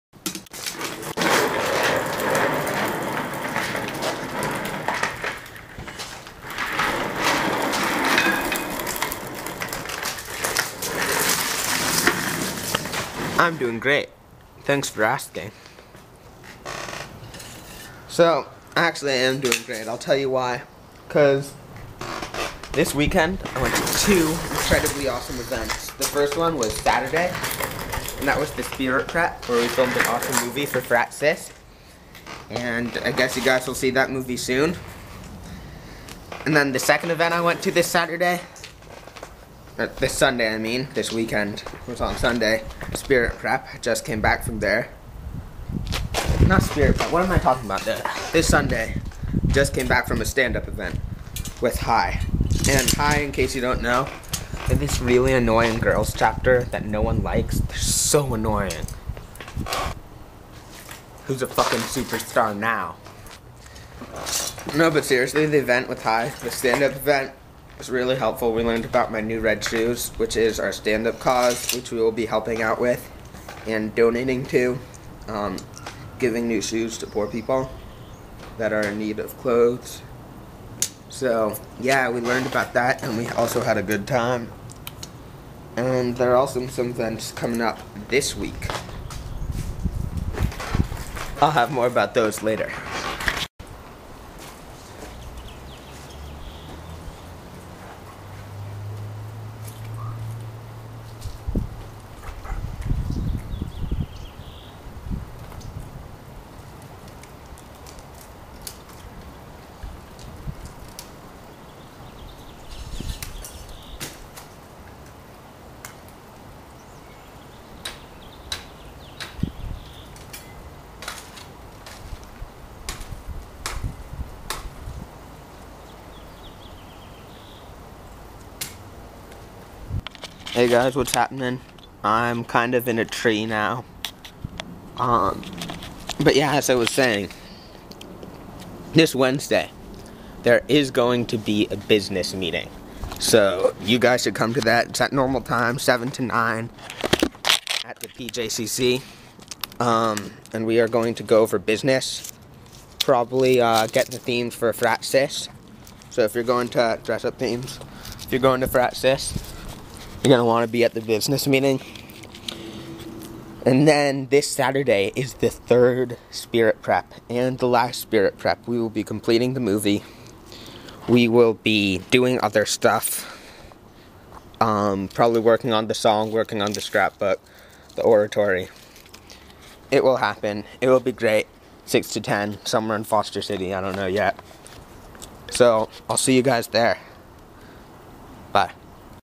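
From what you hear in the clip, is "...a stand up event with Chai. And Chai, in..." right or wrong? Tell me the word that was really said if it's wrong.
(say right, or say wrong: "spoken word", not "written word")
right.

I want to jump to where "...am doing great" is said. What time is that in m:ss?
0:19.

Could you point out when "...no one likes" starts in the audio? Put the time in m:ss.
0:56.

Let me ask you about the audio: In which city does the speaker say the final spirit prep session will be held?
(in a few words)
Foster City.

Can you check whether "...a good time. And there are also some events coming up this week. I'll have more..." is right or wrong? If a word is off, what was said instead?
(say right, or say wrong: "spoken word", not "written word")
right.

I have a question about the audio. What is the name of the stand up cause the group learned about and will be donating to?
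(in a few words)
My New Red Shoes.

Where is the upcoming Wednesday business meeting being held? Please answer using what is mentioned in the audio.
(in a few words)
PJCC.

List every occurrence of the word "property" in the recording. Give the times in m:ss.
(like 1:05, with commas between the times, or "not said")
not said.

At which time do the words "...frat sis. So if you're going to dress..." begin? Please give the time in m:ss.
2:34.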